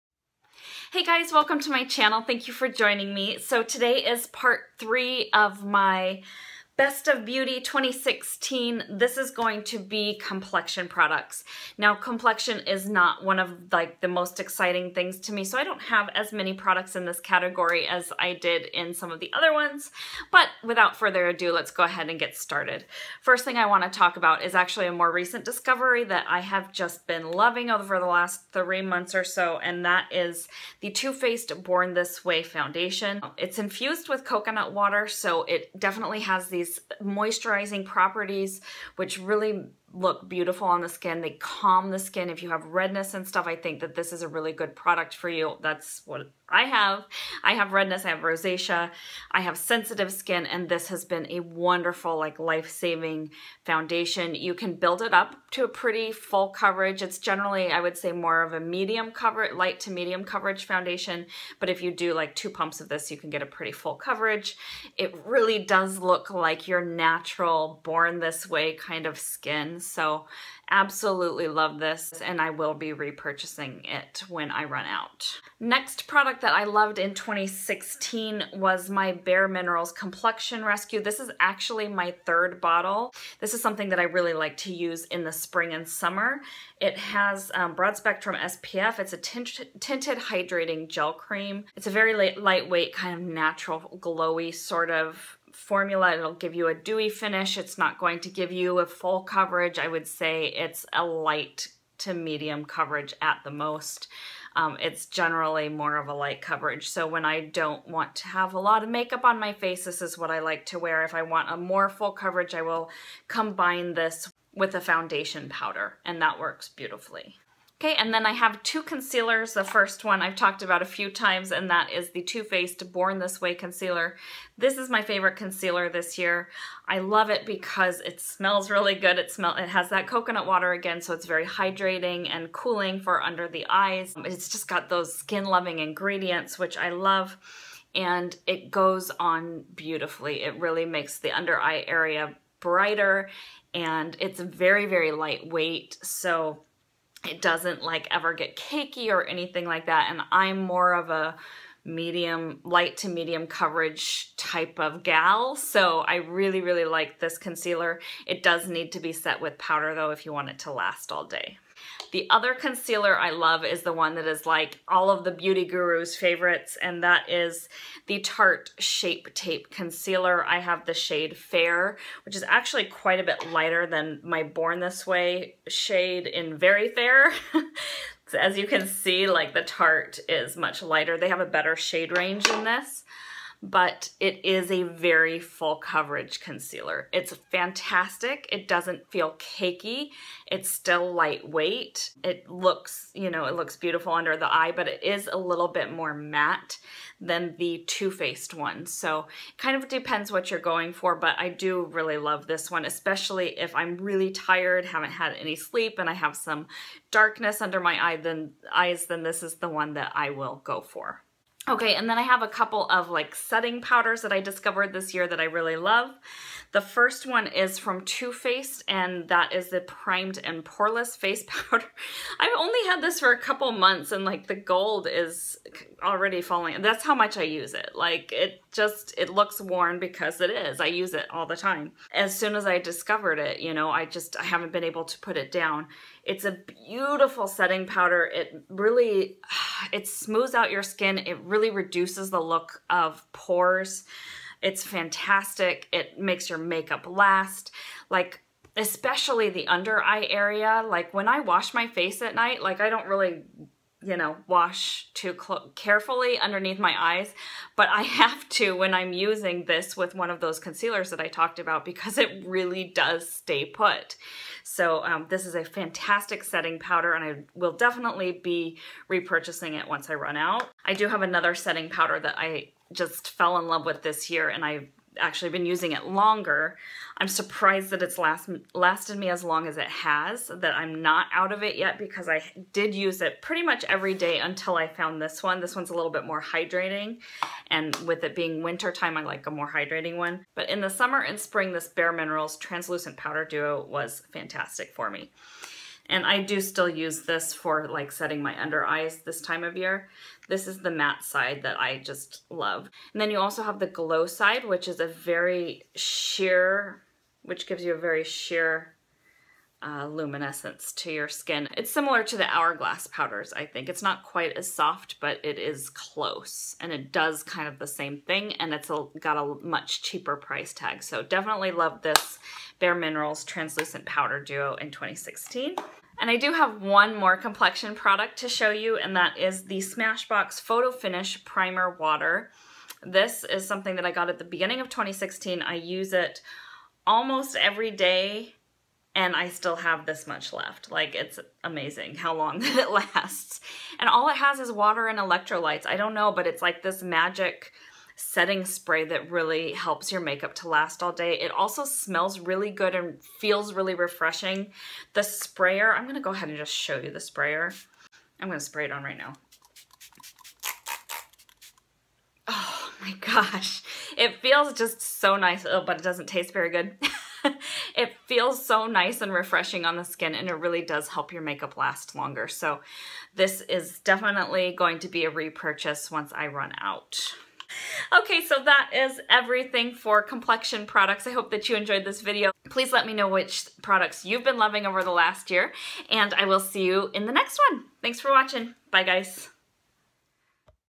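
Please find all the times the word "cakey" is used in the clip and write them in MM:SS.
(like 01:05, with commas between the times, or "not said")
02:28, 03:09.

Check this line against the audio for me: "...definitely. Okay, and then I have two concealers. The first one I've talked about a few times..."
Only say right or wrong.
wrong.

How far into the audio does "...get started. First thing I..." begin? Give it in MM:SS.
00:22.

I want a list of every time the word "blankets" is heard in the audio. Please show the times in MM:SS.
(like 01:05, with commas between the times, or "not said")
not said.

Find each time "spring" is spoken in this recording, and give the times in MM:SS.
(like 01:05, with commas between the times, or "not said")
01:25, 04:51.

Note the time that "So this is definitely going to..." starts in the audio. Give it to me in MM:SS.
06:12.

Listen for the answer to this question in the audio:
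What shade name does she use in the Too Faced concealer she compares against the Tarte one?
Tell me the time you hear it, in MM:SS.
02:56.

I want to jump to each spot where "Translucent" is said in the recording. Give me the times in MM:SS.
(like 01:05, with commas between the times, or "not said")
04:52, 05:23.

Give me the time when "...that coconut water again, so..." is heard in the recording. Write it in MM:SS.
02:09.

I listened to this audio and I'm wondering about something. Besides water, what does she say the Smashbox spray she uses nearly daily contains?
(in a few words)
Electrolytes.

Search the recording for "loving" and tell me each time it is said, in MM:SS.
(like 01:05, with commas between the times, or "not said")
00:27, 02:15, 06:24.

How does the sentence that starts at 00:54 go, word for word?
You can build it up to a pretty full coverage.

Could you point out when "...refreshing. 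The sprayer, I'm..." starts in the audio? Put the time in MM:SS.
05:53.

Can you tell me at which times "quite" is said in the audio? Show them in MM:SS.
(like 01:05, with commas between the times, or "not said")
02:52, 05:14.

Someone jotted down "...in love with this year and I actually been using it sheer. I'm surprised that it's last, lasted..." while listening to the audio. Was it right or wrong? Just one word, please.
wrong.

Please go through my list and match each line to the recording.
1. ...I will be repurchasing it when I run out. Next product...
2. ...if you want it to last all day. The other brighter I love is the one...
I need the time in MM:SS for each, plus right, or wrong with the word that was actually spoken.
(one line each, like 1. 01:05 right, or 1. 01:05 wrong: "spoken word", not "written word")
1. 01:12 right
2. 02:40 wrong: "concealer", not "brighter".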